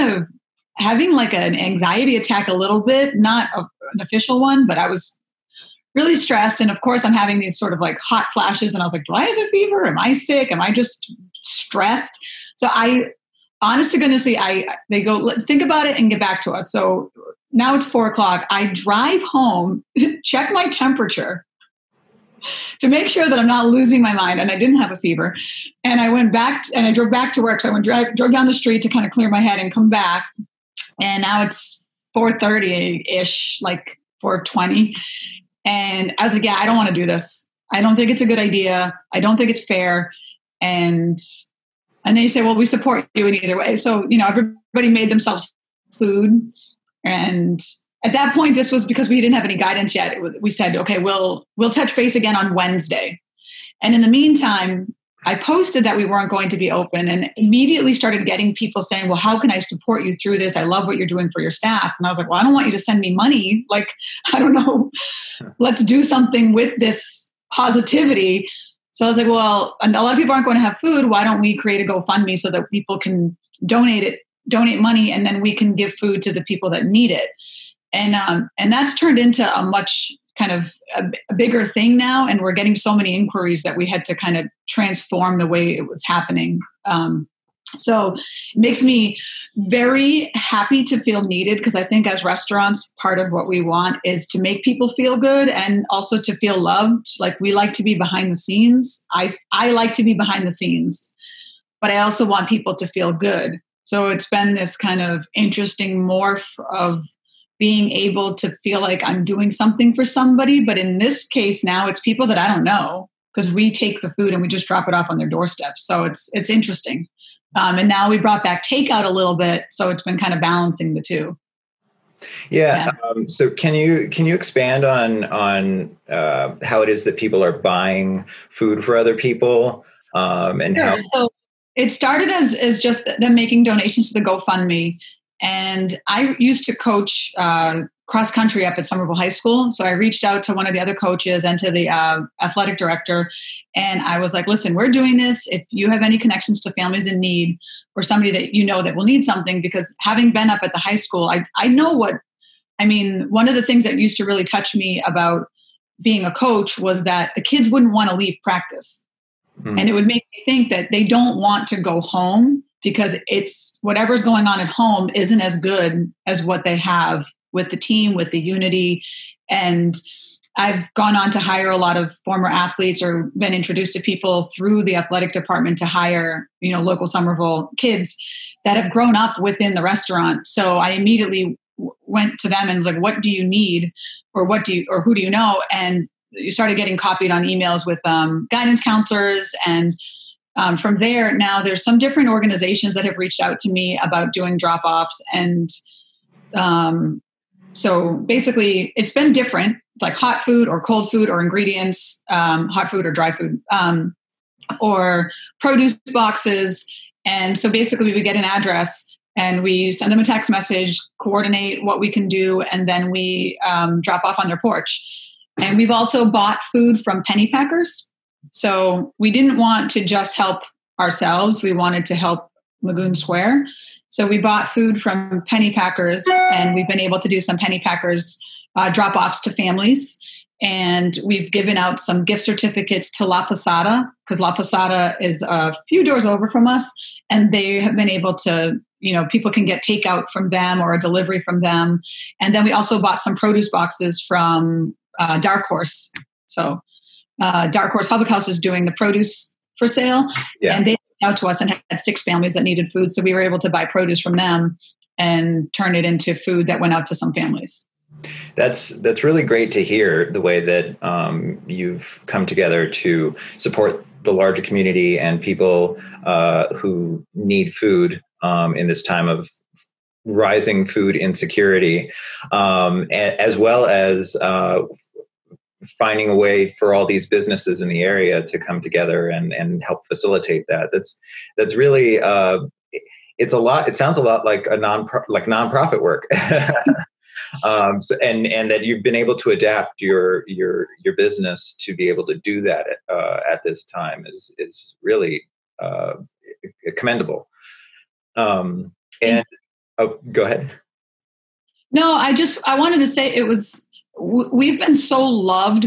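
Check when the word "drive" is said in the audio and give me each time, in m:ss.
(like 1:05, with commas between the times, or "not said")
0:18, 0:27.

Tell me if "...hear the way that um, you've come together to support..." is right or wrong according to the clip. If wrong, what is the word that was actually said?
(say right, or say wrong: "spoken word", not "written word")
right.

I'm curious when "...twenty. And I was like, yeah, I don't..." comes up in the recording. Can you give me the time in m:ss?
0:34.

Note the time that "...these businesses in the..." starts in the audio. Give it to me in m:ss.
4:37.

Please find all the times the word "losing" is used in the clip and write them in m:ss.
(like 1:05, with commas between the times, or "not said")
0:23.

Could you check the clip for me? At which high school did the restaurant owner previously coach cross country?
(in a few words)
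Somerville High School.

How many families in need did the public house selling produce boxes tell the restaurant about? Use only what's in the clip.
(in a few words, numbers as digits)
6.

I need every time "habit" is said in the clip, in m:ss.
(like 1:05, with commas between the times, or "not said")
not said.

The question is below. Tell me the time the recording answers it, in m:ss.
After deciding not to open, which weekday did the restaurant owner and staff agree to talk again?
0:52.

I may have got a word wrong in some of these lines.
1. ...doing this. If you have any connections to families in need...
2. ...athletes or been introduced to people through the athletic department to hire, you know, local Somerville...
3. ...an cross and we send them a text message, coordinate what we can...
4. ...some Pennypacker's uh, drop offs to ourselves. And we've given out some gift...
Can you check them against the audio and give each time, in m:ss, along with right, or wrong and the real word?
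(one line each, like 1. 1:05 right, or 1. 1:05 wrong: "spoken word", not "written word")
1. 2:24 right
2. 2:52 right
3. 3:28 wrong: "address", not "cross"
4. 3:47 wrong: "families", not "ourselves".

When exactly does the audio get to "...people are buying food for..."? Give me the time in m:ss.
2:07.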